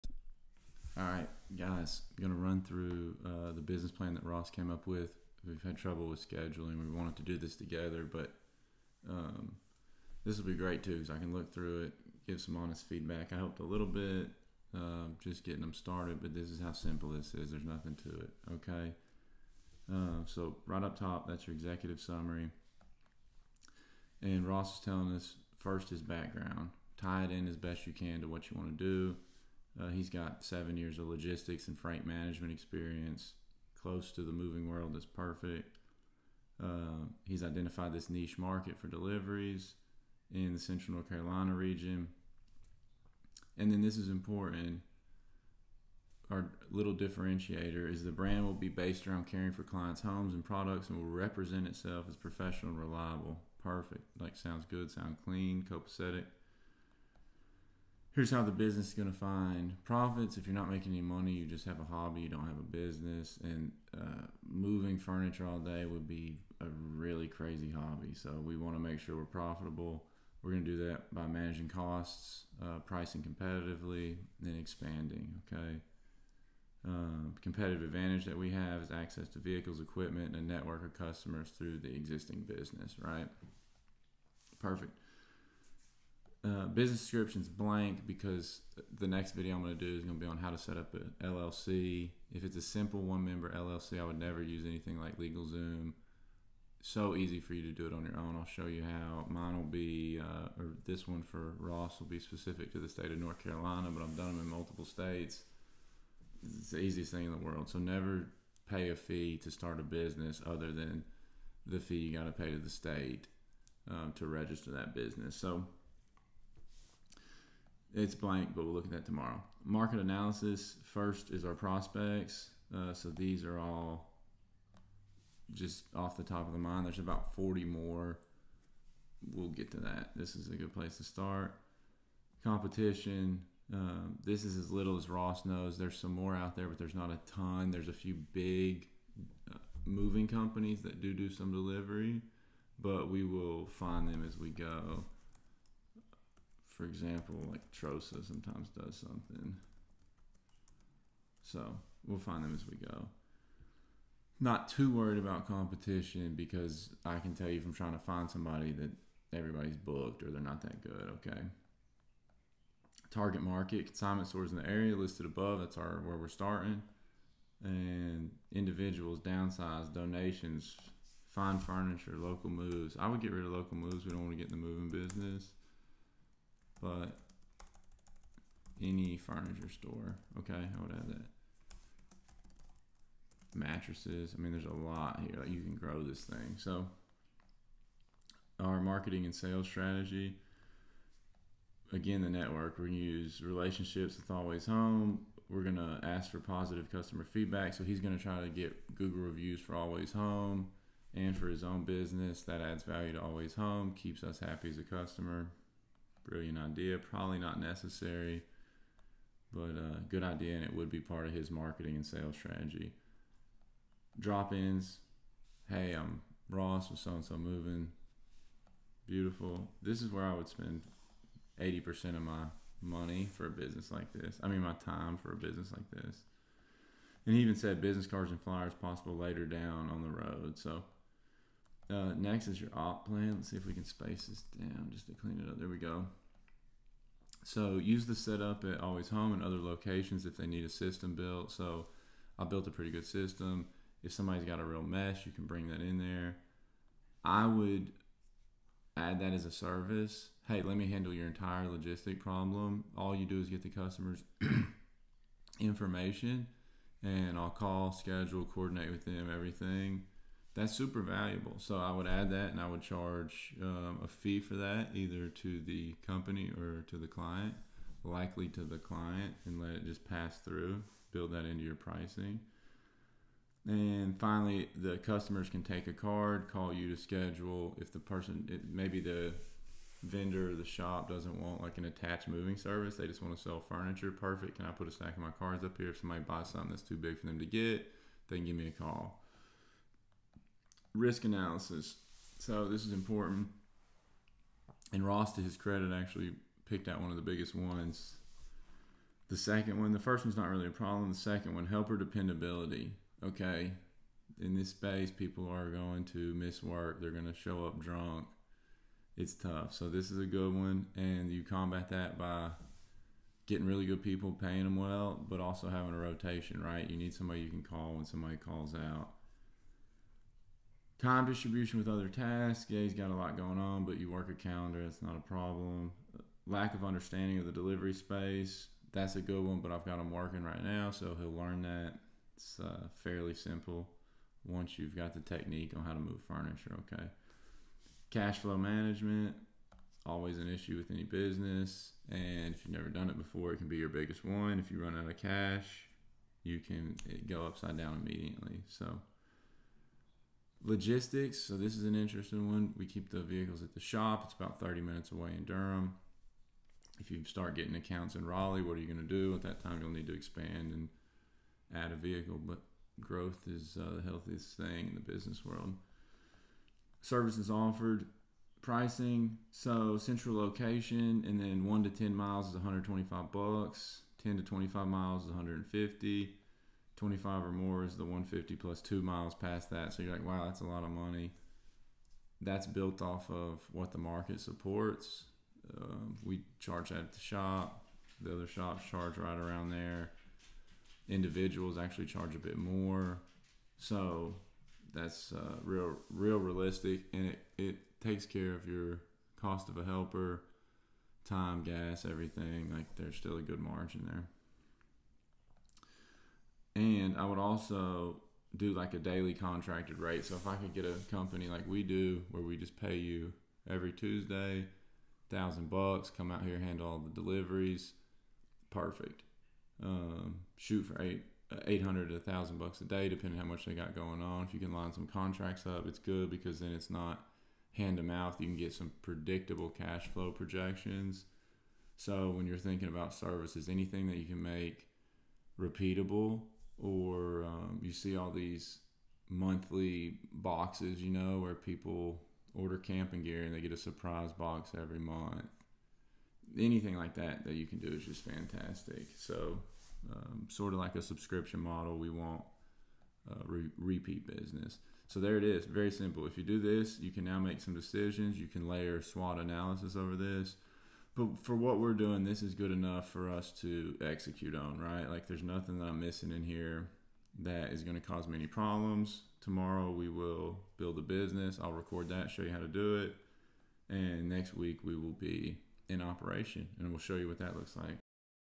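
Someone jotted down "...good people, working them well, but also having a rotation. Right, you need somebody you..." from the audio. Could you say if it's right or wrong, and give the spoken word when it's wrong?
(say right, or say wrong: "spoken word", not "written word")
wrong: "paying", not "working".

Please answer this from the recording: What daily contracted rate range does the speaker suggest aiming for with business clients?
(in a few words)
$800 to $1000.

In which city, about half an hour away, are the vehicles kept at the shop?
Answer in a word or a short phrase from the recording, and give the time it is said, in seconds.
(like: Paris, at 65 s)
Durham, at 355 s.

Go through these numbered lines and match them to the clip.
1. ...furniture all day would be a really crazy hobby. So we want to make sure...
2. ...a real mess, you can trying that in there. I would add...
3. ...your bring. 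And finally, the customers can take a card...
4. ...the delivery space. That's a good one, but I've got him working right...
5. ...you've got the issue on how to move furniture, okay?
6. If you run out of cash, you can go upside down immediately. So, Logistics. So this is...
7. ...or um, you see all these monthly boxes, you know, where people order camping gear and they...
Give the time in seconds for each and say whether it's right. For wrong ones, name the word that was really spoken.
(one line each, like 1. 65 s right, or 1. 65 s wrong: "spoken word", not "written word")
1. 64 s right
2. 244 s wrong: "bring", not "trying"
3. 271 s wrong: "pricing", not "bring"
4. 327 s right
5. 334 s wrong: "technique", not "issue"
6. 344 s right
7. 436 s right.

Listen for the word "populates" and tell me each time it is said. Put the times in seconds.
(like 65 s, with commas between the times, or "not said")
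not said.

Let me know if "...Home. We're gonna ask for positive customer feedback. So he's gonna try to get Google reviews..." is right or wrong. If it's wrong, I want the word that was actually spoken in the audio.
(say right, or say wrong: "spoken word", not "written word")
right.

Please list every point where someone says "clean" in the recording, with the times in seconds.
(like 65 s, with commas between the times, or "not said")
55 s, 235 s.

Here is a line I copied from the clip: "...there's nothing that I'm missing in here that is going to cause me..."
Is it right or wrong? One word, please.
right.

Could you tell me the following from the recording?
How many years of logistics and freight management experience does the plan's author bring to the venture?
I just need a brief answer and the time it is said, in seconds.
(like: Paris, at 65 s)
7, at 30 s.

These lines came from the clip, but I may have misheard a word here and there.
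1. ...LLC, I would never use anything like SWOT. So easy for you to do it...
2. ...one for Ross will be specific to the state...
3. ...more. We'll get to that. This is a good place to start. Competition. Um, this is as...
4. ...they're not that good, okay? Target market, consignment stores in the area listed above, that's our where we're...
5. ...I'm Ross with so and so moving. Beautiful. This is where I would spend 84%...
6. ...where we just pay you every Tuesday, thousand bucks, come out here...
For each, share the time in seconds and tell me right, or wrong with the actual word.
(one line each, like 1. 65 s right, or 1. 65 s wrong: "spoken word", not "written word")
1. 93 s wrong: "LegalZoom", not "SWOT"
2. 101 s right
3. 127 s right
4. 160 s right
5. 215 s wrong: "80", not "84"
6. 412 s right.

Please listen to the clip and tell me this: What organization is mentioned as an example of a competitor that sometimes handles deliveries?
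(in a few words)
Trosa.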